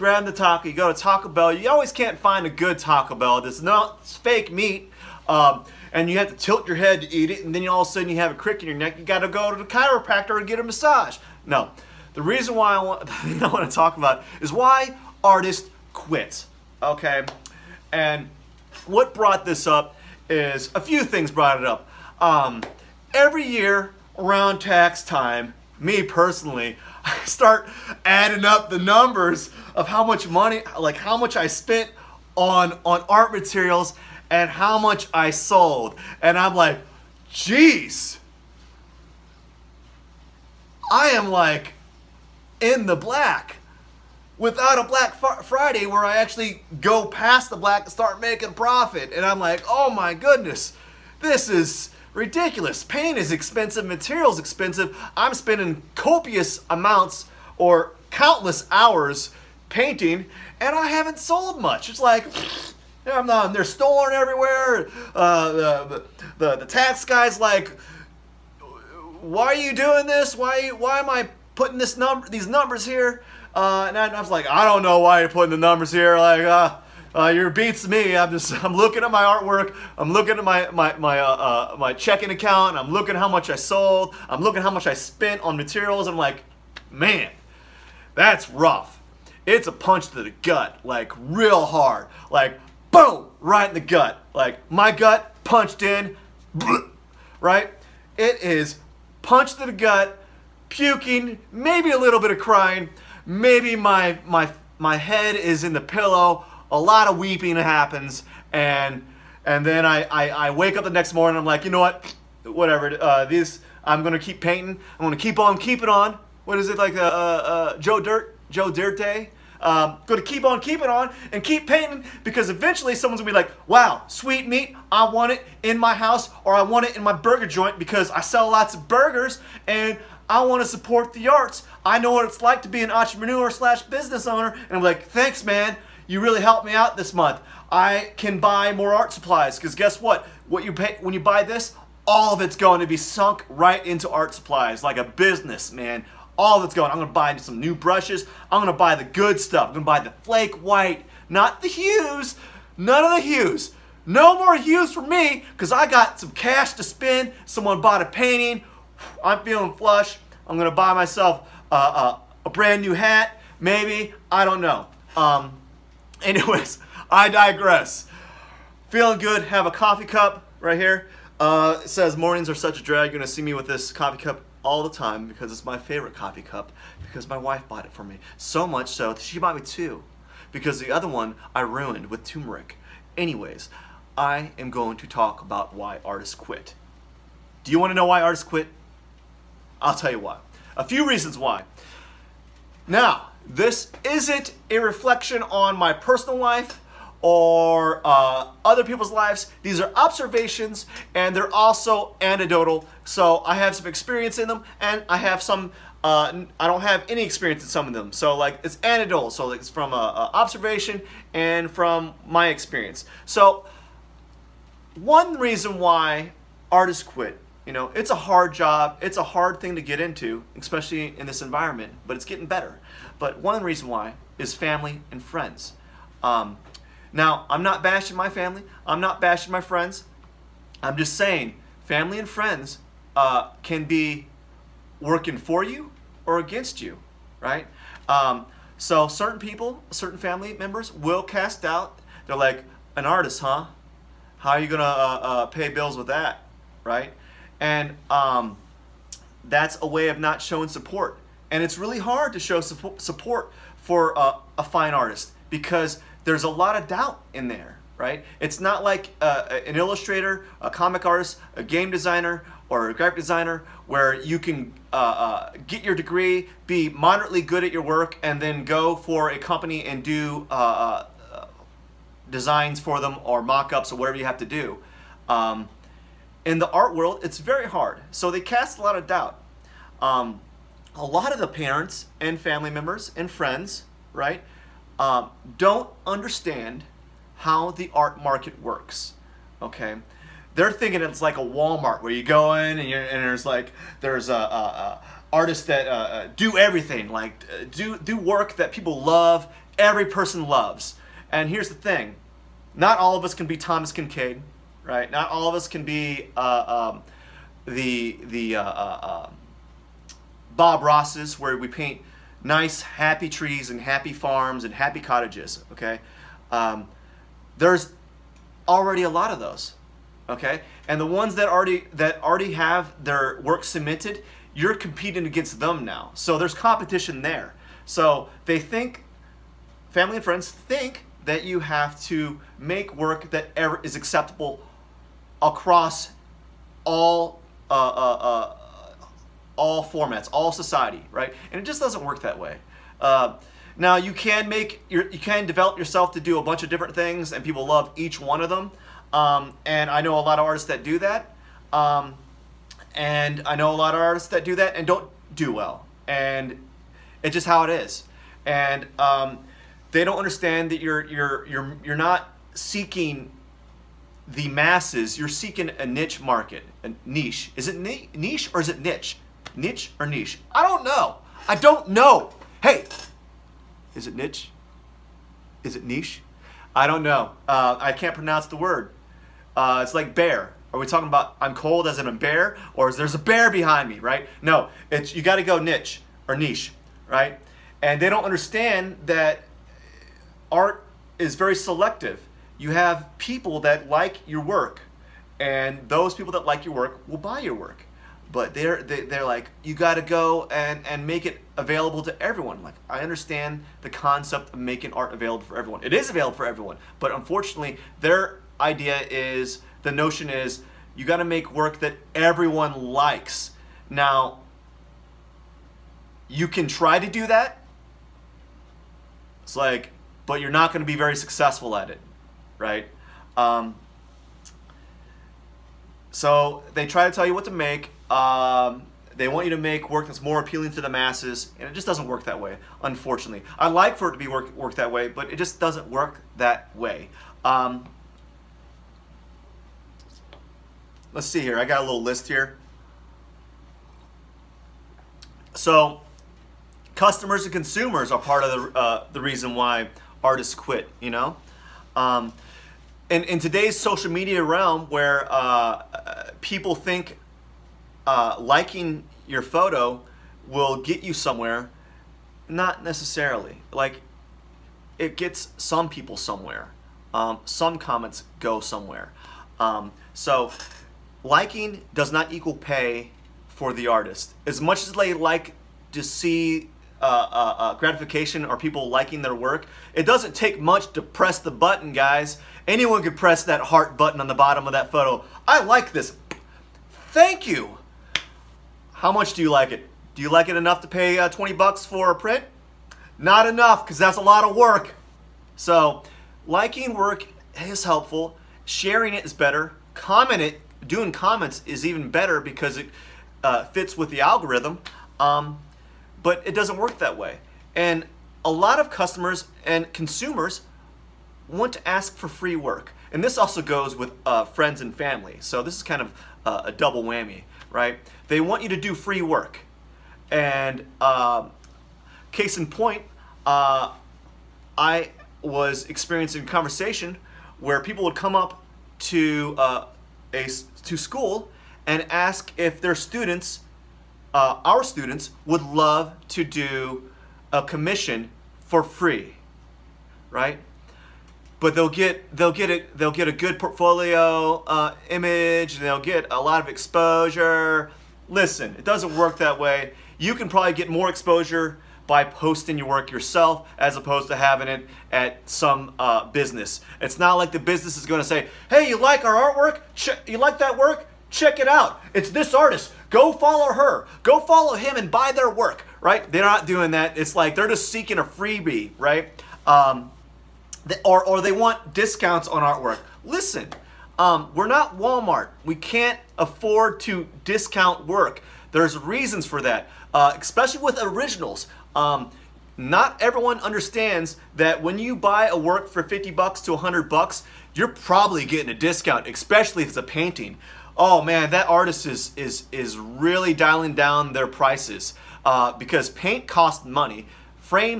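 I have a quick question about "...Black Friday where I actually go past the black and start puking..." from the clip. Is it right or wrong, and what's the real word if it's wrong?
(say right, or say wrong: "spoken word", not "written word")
wrong: "making", not "puking".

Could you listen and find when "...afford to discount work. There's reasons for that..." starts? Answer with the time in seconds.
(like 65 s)
576 s.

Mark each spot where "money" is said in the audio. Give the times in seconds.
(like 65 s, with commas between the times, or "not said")
30 s, 596 s.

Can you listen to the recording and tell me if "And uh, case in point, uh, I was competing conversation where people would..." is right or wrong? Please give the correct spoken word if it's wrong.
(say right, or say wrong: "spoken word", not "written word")
wrong: "experiencing", not "competing".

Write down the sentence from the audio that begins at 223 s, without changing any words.
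But one reason why is family and friends.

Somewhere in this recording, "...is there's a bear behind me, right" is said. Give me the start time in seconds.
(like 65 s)
382 s.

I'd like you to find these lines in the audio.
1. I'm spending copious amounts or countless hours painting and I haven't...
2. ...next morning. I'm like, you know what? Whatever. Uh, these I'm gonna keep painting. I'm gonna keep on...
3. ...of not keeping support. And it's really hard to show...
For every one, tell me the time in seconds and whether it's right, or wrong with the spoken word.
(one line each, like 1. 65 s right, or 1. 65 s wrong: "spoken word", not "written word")
1. 55 s right
2. 110 s right
3. 250 s wrong: "showing", not "keeping".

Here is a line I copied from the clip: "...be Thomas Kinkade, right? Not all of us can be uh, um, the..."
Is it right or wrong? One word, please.
right.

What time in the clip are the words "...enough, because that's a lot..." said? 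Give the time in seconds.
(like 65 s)
493 s.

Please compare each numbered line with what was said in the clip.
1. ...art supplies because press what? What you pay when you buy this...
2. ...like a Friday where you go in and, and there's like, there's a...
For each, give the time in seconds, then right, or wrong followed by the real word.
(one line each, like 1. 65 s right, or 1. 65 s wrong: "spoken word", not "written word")
1. 138 s wrong: "guess", not "press"
2. 291 s wrong: "Walmart", not "Friday".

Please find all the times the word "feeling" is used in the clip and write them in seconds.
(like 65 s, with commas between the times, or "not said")
159 s, 168 s.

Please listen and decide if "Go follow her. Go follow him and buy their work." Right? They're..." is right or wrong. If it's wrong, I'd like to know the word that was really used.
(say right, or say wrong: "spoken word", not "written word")
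right.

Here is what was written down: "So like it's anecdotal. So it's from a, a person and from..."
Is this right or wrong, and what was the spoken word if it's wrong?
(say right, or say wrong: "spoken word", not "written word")
wrong: "observation", not "person".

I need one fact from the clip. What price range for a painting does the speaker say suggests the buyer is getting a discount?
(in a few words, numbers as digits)
$50 to $100.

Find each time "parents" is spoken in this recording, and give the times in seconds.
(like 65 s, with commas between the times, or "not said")
281 s.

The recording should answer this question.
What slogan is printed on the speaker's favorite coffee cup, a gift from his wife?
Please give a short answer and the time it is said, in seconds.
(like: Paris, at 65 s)
Mornings are such a drag, at 172 s.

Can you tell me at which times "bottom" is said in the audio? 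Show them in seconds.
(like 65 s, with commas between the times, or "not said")
484 s.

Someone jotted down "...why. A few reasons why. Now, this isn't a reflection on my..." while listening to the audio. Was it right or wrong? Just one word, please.
right.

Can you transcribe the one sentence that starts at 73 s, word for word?
Uh, and I, was like, I don't know why you're putting the numbers here.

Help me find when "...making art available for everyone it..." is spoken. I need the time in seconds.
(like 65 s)
404 s.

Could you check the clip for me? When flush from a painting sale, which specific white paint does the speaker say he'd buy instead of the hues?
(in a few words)
flake white.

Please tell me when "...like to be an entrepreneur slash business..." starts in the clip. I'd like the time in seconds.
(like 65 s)
132 s.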